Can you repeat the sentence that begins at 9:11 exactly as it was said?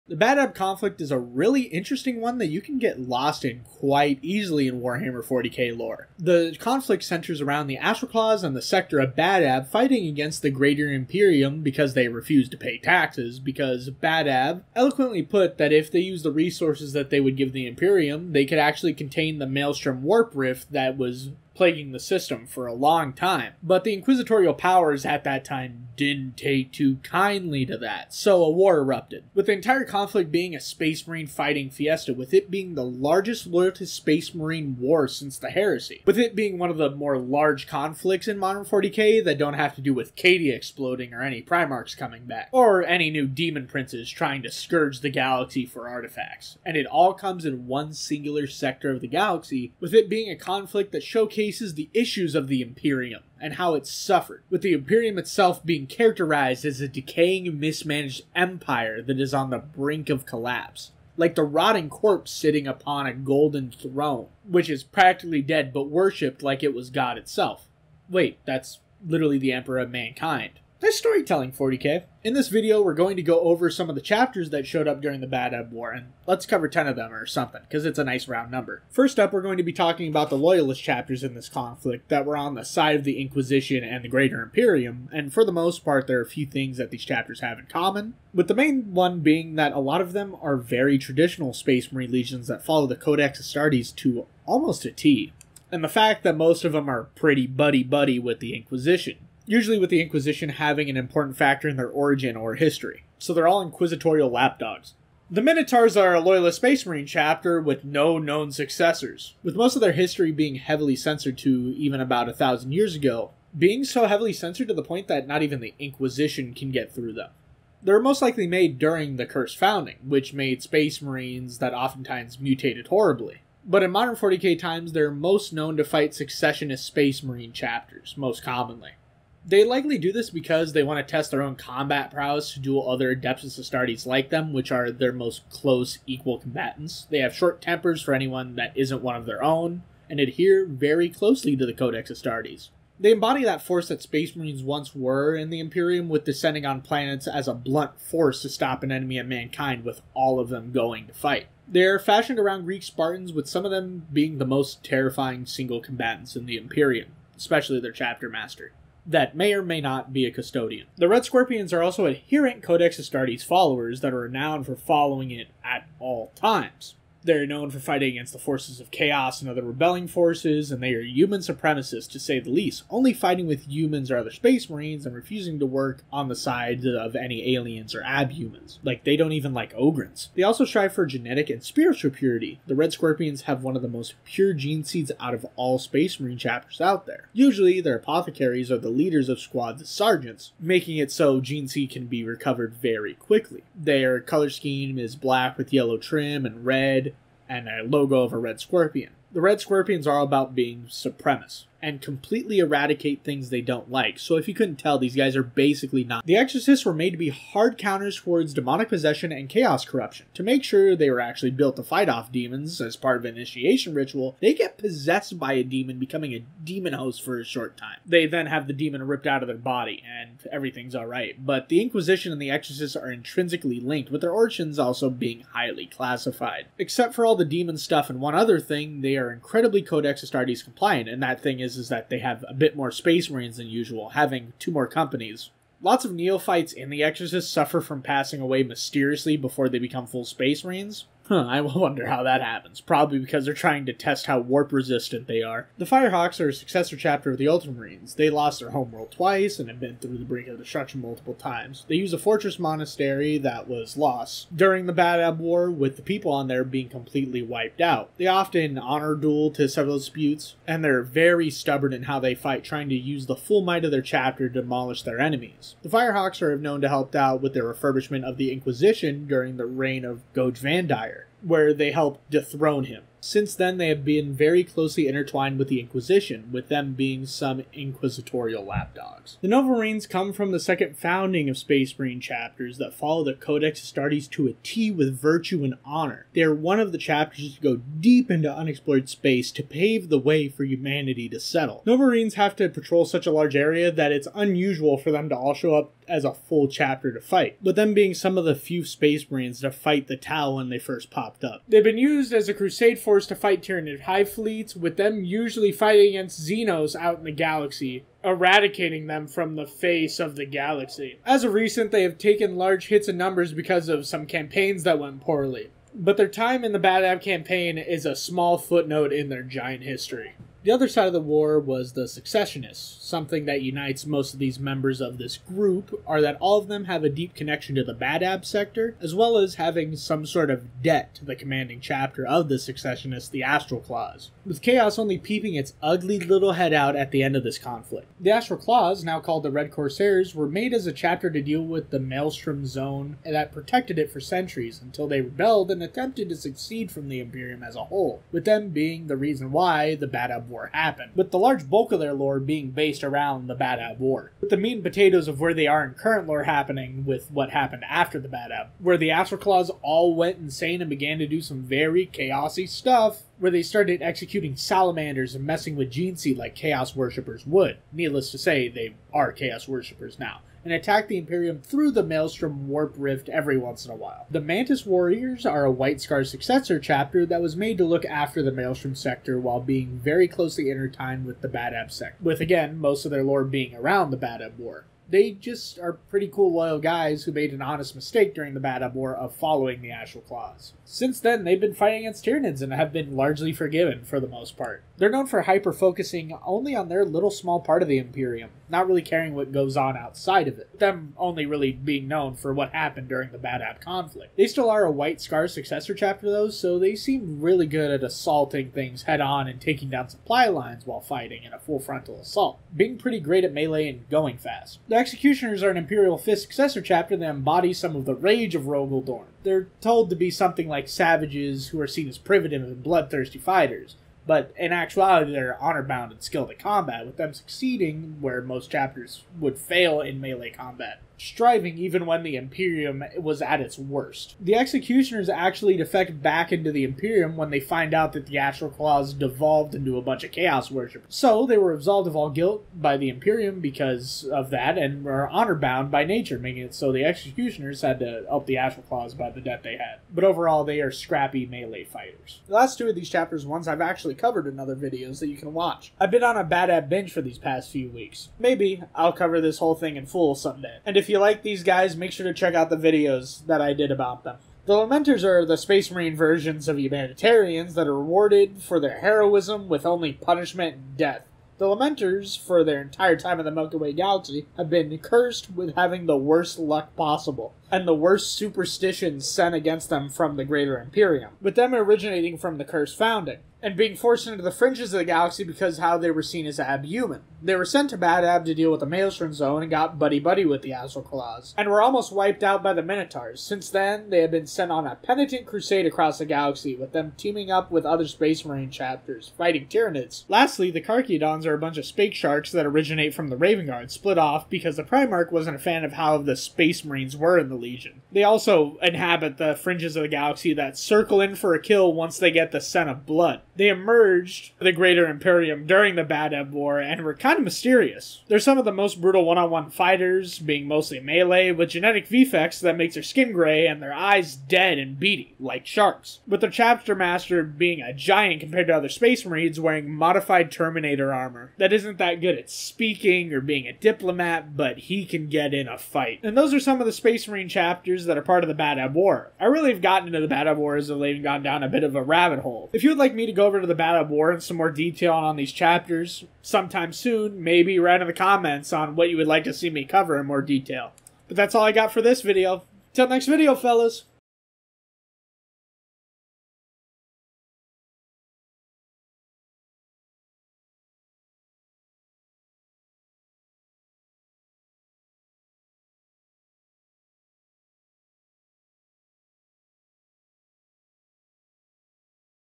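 But that's all I got for this video.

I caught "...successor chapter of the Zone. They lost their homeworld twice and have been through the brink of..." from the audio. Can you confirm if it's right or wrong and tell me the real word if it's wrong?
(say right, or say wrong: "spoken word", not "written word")
wrong: "Ultramarines", not "Zone".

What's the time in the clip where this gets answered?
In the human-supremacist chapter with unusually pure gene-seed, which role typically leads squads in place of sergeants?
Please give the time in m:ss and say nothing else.
3:07.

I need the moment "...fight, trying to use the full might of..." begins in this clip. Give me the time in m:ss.
4:22.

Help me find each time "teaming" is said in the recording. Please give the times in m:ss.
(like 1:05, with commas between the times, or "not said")
8:17.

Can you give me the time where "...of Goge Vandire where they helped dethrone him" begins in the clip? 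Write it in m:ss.
4:30.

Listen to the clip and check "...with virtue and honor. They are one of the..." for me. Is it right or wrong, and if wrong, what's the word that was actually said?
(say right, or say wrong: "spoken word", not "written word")
right.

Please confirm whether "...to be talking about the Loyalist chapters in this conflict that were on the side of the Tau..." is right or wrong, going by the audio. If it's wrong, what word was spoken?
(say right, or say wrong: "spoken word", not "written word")
wrong: "Inquisition", not "Tau".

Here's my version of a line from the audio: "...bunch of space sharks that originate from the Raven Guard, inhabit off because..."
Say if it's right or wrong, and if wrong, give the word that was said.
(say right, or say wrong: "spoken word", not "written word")
wrong: "split", not "inhabit".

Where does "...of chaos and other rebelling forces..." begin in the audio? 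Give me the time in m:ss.
2:48.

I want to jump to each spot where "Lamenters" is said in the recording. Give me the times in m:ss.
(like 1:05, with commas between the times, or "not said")
7:44, 7:51.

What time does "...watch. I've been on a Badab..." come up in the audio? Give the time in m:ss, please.
7:35.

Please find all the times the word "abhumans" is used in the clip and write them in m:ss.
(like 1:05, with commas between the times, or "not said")
2:58, 8:06.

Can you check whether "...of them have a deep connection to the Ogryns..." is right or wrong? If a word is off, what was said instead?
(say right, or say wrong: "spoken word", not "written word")
wrong: "Badab", not "Ogryns".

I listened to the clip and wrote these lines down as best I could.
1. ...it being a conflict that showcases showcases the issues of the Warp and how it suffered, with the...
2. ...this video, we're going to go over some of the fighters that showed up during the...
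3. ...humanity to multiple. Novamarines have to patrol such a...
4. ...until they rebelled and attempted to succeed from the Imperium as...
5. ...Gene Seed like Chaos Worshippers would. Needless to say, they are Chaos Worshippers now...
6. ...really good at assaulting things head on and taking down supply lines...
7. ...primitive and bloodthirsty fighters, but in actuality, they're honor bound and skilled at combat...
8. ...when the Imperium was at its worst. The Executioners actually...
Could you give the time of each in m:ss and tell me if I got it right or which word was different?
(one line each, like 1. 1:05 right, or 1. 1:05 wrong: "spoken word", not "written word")
1. 0:49 wrong: "Imperium", not "Warp"
2. 1:12 wrong: "chapters", not "fighters"
3. 4:50 wrong: "settle", not "multiple"
4. 5:44 right
5. 6:05 right
6. 6:47 right
7. 7:02 right
8. 7:12 right.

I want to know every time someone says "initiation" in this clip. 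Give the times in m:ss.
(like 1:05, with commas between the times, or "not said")
3:33.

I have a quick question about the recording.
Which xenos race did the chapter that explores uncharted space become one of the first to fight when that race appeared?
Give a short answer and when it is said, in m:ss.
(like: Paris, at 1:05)
The Tau, at 5:00.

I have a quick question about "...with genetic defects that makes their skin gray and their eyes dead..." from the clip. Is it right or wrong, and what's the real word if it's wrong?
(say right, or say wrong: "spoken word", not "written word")
right.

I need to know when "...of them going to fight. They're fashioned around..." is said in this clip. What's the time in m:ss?
2:30.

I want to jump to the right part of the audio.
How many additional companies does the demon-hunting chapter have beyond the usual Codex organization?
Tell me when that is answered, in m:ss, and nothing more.
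3:54.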